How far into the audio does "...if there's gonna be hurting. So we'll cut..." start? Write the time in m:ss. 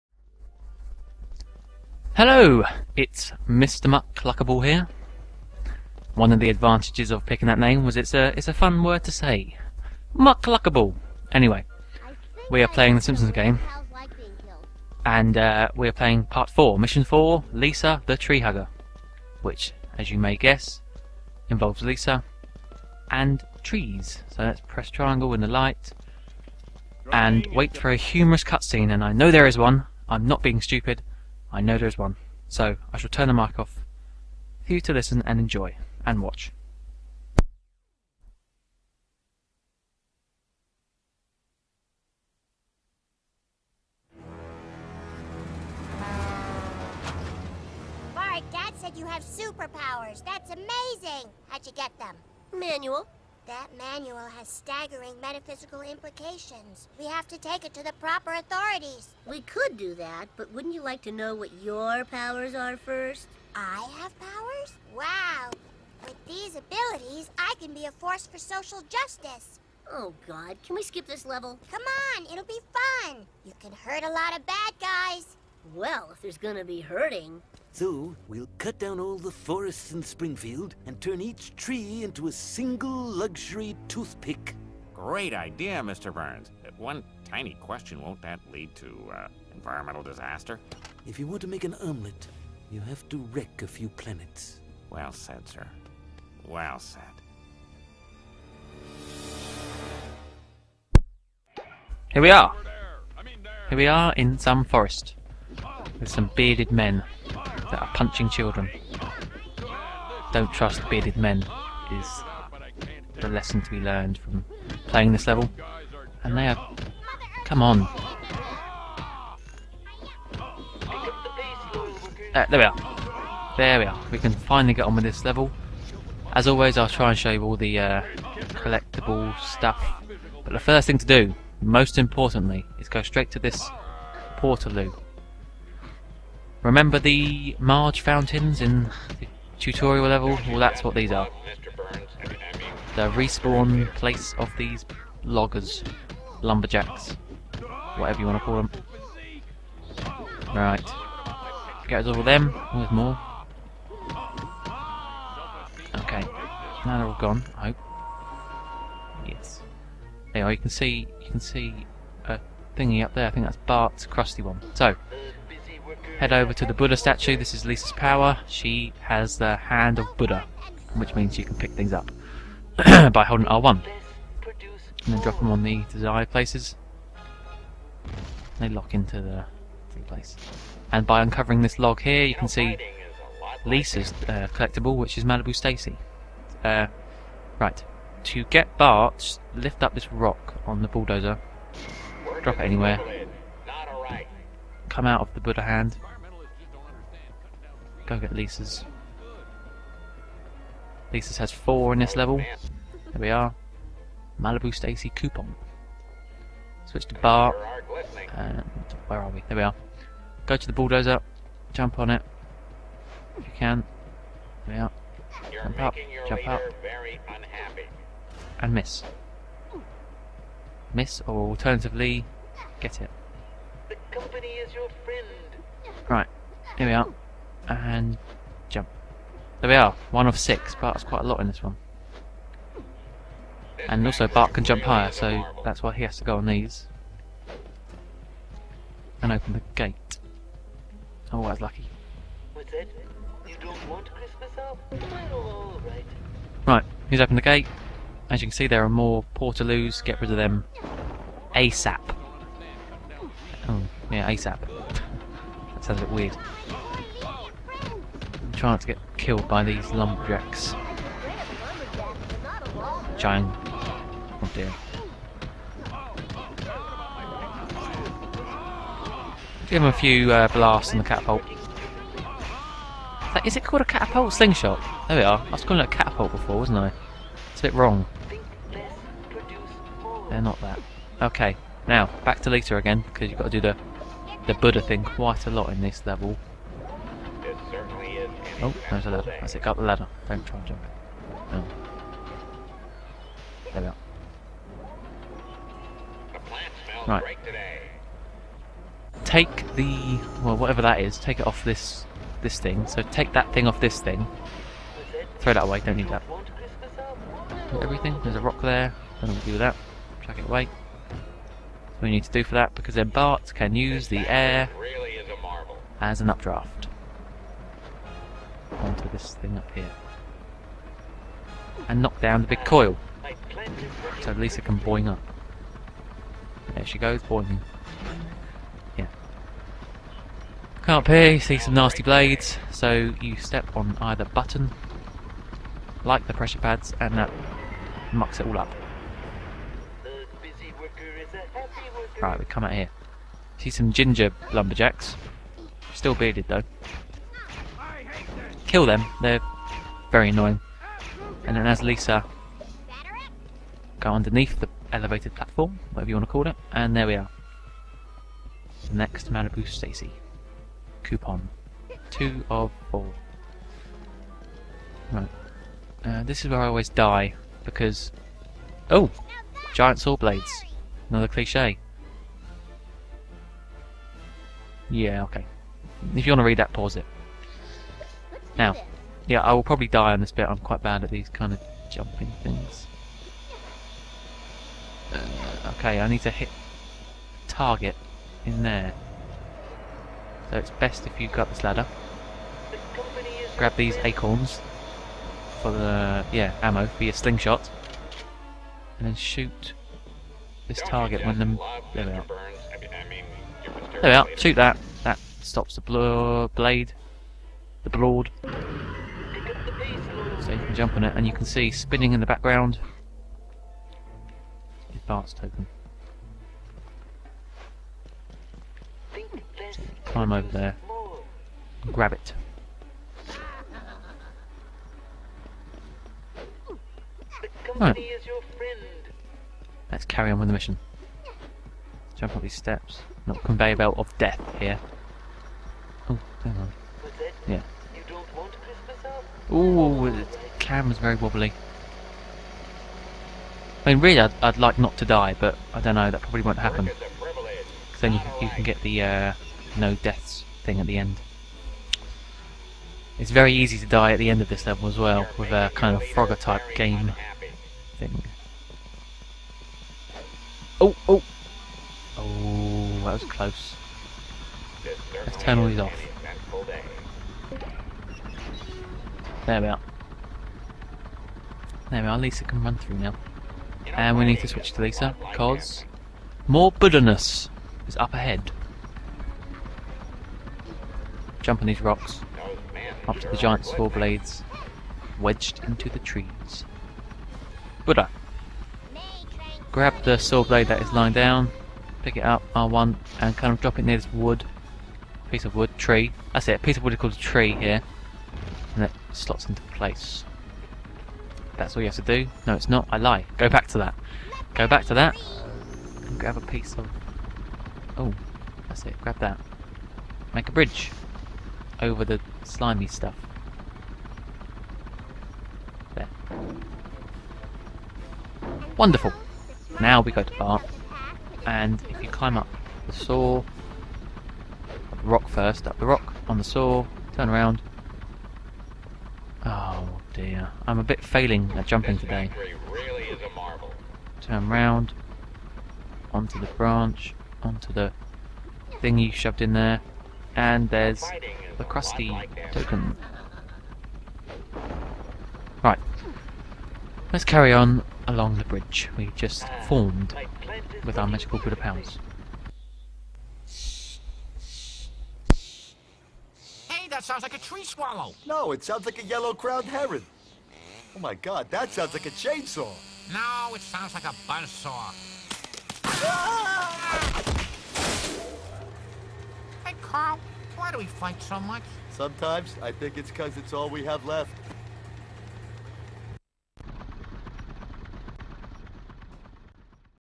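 1:16.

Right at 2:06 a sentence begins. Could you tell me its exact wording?
As always, I'll try and show you all the uh, collectible stuff.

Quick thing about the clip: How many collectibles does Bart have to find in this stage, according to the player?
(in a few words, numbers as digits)
6.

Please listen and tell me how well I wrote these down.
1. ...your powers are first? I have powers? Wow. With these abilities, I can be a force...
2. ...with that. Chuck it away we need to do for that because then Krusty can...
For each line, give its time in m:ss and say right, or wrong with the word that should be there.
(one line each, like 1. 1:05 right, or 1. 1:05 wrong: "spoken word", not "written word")
1. 1:01 right
2. 5:09 wrong: "Bart", not "Krusty".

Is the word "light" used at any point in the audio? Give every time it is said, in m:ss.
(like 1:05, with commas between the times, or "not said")
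0:25.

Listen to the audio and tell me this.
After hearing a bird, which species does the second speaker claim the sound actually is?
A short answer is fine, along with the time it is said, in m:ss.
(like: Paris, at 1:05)
yellow-crowned heron, at 9:19.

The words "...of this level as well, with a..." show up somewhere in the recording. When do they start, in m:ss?
7:34.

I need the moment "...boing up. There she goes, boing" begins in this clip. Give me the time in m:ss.
5:24.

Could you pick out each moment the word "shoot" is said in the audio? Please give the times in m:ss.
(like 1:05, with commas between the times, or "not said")
6:39, 6:44.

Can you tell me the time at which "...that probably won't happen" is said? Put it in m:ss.
7:26.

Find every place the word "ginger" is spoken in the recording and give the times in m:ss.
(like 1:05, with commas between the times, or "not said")
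5:43.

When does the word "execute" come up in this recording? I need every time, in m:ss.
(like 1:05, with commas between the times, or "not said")
not said.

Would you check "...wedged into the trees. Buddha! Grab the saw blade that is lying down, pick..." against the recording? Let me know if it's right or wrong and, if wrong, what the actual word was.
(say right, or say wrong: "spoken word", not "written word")
right.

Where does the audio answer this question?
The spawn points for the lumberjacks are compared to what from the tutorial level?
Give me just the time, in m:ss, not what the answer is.
2:17.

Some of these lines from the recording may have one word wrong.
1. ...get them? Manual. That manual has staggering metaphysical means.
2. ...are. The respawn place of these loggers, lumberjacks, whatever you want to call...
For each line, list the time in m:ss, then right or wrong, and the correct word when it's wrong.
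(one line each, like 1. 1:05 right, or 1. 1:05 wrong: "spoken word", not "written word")
1. 0:51 wrong: "implications", not "means"
2. 2:21 right.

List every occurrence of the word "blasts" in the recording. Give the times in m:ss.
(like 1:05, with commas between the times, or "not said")
4:30.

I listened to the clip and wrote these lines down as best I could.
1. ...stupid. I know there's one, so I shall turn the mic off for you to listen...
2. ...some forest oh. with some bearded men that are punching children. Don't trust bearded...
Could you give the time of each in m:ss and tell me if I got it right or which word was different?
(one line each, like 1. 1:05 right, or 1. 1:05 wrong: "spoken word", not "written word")
1. 0:30 right
2. 1:44 right.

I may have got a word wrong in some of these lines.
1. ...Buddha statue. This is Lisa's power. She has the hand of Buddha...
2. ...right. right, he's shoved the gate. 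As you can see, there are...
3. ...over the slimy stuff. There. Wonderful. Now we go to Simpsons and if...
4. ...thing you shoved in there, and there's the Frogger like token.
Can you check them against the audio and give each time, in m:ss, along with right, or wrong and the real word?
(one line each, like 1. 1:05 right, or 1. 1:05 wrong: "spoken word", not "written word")
1. 2:46 right
2. 4:05 wrong: "opened", not "shoved"
3. 8:31 wrong: "Bart", not "Simpsons"
4. 8:58 wrong: "Krusty", not "Frogger".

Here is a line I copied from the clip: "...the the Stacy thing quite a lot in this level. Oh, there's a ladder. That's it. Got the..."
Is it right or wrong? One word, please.
wrong.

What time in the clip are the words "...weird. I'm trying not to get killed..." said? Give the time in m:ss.
4:16.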